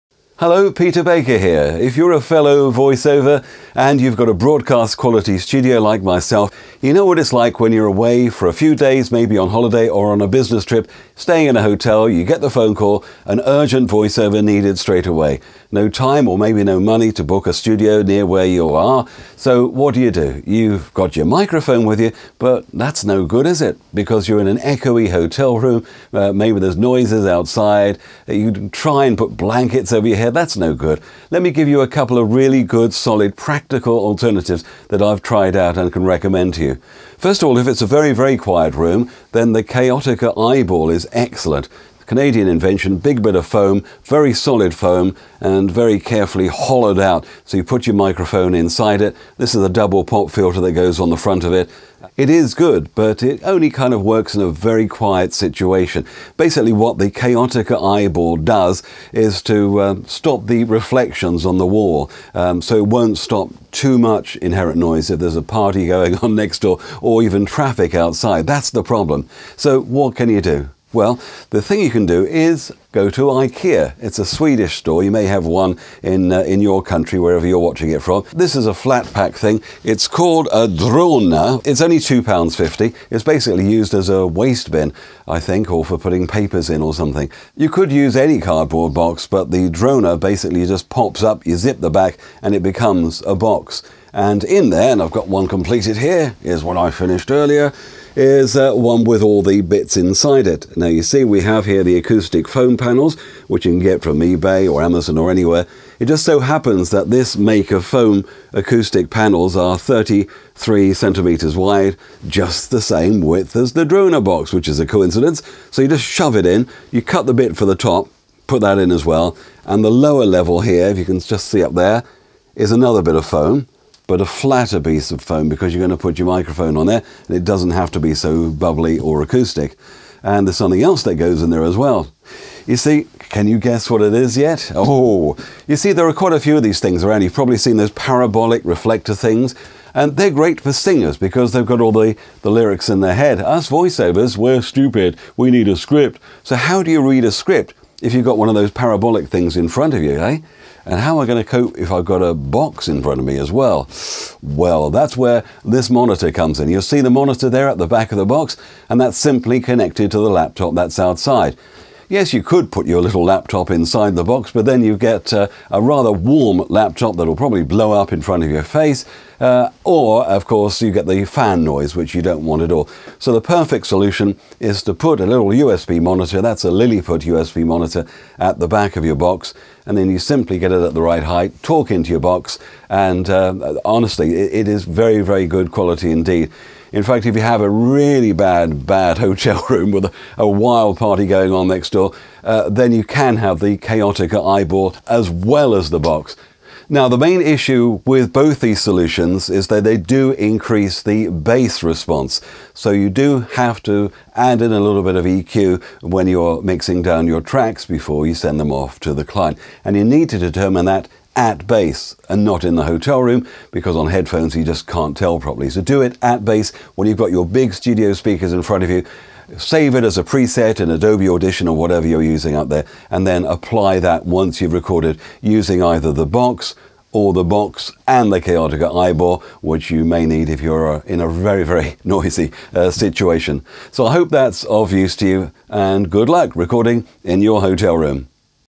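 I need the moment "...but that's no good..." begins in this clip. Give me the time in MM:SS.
00:22.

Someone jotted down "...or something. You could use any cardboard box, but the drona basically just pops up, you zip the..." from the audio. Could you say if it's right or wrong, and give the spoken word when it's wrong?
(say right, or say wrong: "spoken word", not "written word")
right.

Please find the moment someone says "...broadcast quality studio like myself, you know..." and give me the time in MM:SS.
00:04.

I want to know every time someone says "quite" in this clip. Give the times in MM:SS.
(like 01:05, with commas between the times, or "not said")
02:16.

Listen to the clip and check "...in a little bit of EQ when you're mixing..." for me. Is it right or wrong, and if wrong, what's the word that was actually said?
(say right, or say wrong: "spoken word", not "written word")
right.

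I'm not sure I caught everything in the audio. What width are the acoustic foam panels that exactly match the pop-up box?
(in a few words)
33 centimeters.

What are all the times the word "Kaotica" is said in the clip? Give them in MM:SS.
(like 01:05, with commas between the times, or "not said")
00:39, 00:57, 03:13, 03:48.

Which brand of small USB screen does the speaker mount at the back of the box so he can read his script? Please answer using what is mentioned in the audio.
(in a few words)
Lilliput.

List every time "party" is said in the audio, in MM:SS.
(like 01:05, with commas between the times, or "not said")
01:05, 03:10.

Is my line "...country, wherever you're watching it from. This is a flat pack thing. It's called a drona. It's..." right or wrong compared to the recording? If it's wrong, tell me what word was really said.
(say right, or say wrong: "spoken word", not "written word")
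right.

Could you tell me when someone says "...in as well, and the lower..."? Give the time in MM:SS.
01:58.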